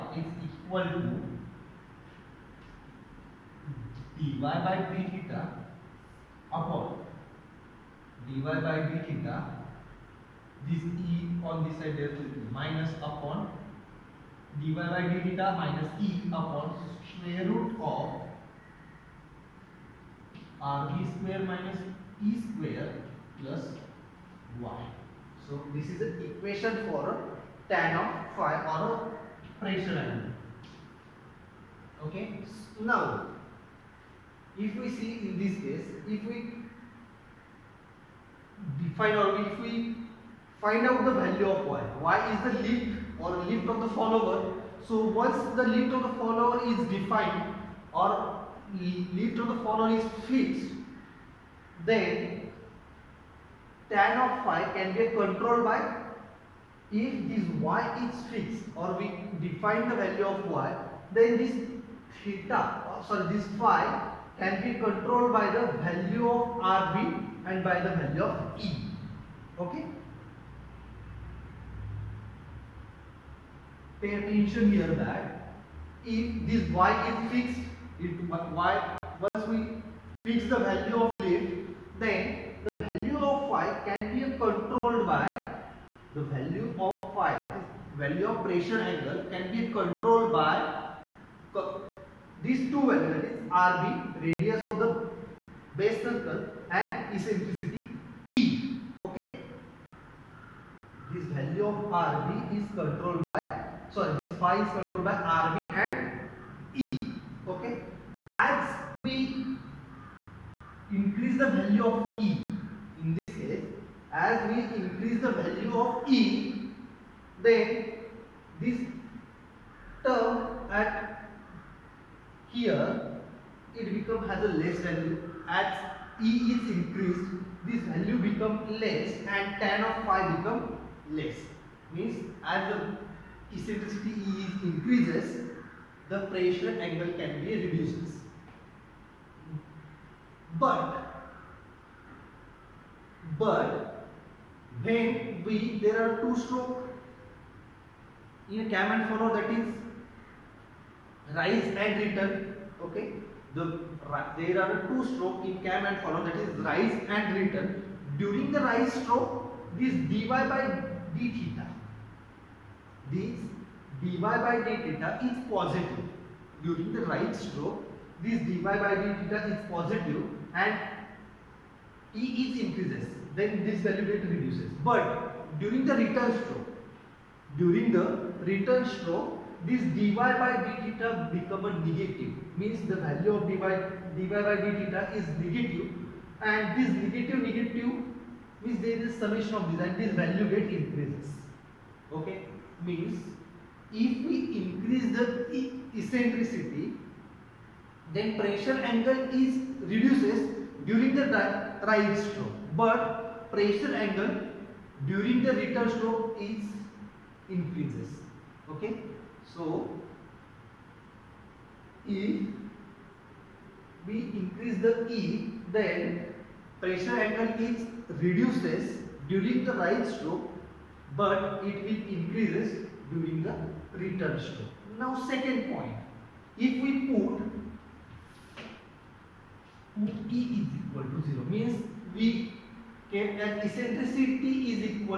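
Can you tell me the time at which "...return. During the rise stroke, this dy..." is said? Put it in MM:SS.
02:37.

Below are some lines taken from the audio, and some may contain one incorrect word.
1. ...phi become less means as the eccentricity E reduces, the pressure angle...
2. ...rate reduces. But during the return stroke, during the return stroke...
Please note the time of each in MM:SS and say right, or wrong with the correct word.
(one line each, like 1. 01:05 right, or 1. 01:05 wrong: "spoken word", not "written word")
1. 02:10 wrong: "increases", not "reduces"
2. 02:54 right.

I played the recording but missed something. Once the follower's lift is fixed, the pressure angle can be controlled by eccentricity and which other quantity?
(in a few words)
Radius of the base circle.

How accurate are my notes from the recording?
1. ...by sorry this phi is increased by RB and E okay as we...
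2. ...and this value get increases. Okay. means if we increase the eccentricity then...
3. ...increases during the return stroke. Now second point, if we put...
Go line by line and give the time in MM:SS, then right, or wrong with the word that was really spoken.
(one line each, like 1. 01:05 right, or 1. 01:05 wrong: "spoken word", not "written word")
1. 01:43 wrong: "controlled", not "increased"
2. 03:09 right
3. 03:42 right.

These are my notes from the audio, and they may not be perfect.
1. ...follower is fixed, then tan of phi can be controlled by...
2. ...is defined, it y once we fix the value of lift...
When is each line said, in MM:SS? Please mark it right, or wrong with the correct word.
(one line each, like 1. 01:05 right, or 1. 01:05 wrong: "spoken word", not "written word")
1. 00:49 right
2. 01:17 wrong: "fixed", not "defined".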